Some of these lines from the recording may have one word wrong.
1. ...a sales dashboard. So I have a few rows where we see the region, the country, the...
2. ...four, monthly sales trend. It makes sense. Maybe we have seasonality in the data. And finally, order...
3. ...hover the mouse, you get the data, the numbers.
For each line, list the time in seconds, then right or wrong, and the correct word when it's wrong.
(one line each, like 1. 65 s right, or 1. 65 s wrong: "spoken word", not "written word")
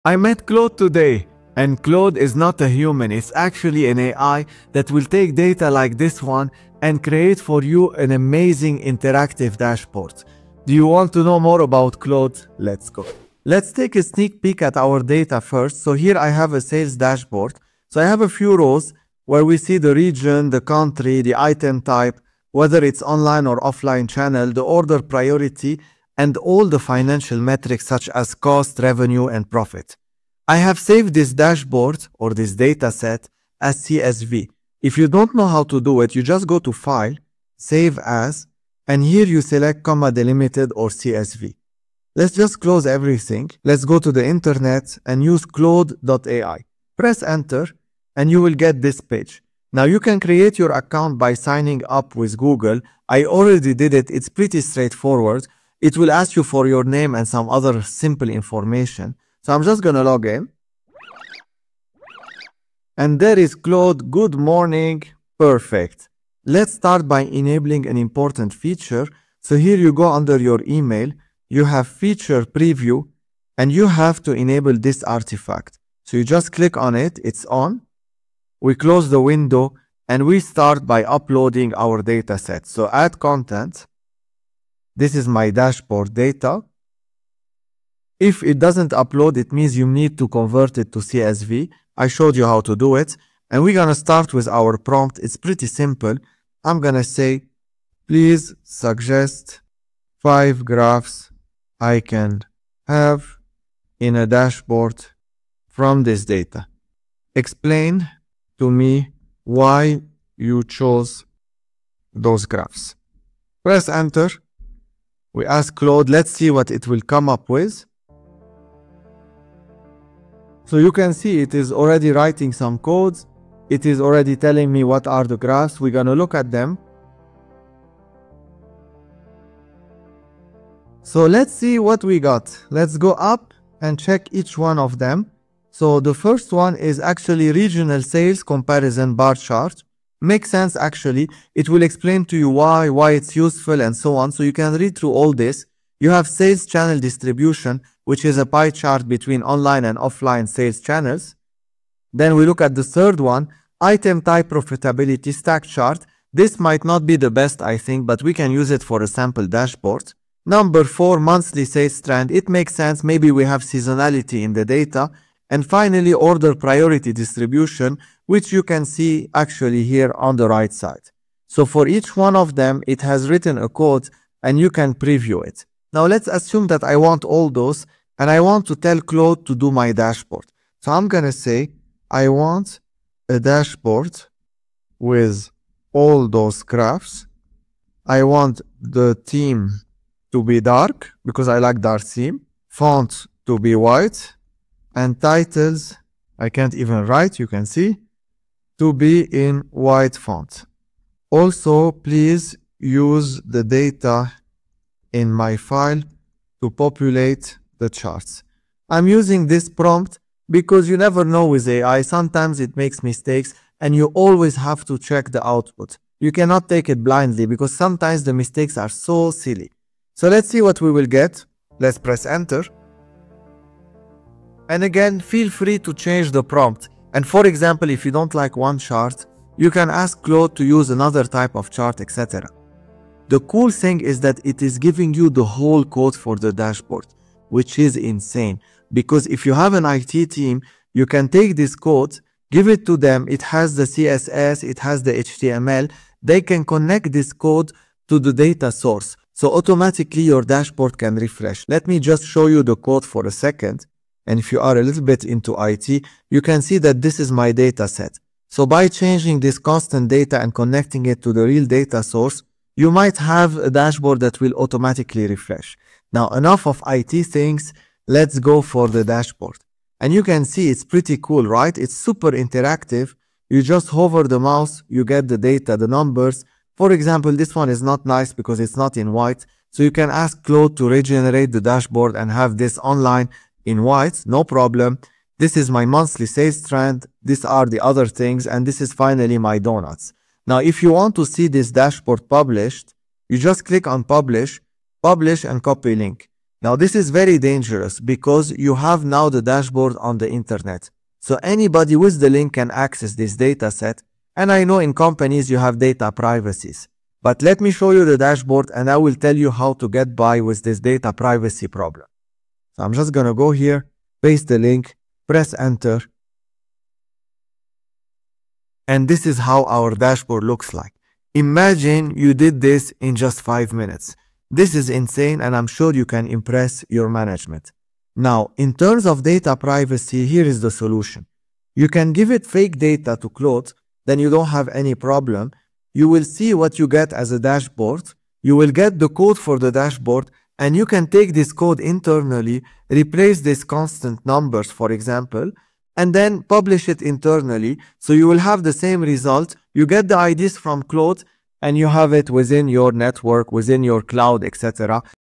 1. 16 s right
2. 160 s right
3. 273 s right.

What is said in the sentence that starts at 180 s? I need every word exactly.
So I'm going to say, I want a dashboard with all those graphs.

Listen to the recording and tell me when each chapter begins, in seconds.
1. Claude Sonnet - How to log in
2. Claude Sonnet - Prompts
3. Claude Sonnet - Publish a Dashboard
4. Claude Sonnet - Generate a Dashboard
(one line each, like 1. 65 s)
1. 13 s
2. 67 s
3. 288 s
4. 180 s.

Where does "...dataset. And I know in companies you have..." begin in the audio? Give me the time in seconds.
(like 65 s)
303 s.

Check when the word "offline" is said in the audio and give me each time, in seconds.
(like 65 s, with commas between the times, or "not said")
23 s, 149 s.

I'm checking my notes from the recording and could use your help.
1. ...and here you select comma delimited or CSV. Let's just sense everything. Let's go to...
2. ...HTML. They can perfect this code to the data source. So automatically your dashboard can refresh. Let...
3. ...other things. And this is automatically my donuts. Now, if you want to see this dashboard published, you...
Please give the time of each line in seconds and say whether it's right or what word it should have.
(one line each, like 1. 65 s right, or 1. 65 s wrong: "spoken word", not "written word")
1. 38 s wrong: "close", not "sense"
2. 245 s wrong: "connect", not "perfect"
3. 287 s wrong: "finally", not "automatically".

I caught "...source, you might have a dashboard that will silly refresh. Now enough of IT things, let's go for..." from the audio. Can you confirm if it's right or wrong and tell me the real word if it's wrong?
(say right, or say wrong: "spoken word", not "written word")
wrong: "automatically", not "silly".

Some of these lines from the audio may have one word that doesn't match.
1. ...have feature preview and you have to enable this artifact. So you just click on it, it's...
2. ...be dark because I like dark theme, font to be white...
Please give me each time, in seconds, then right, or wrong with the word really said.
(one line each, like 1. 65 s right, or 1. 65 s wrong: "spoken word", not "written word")
1. 71 s right
2. 190 s right.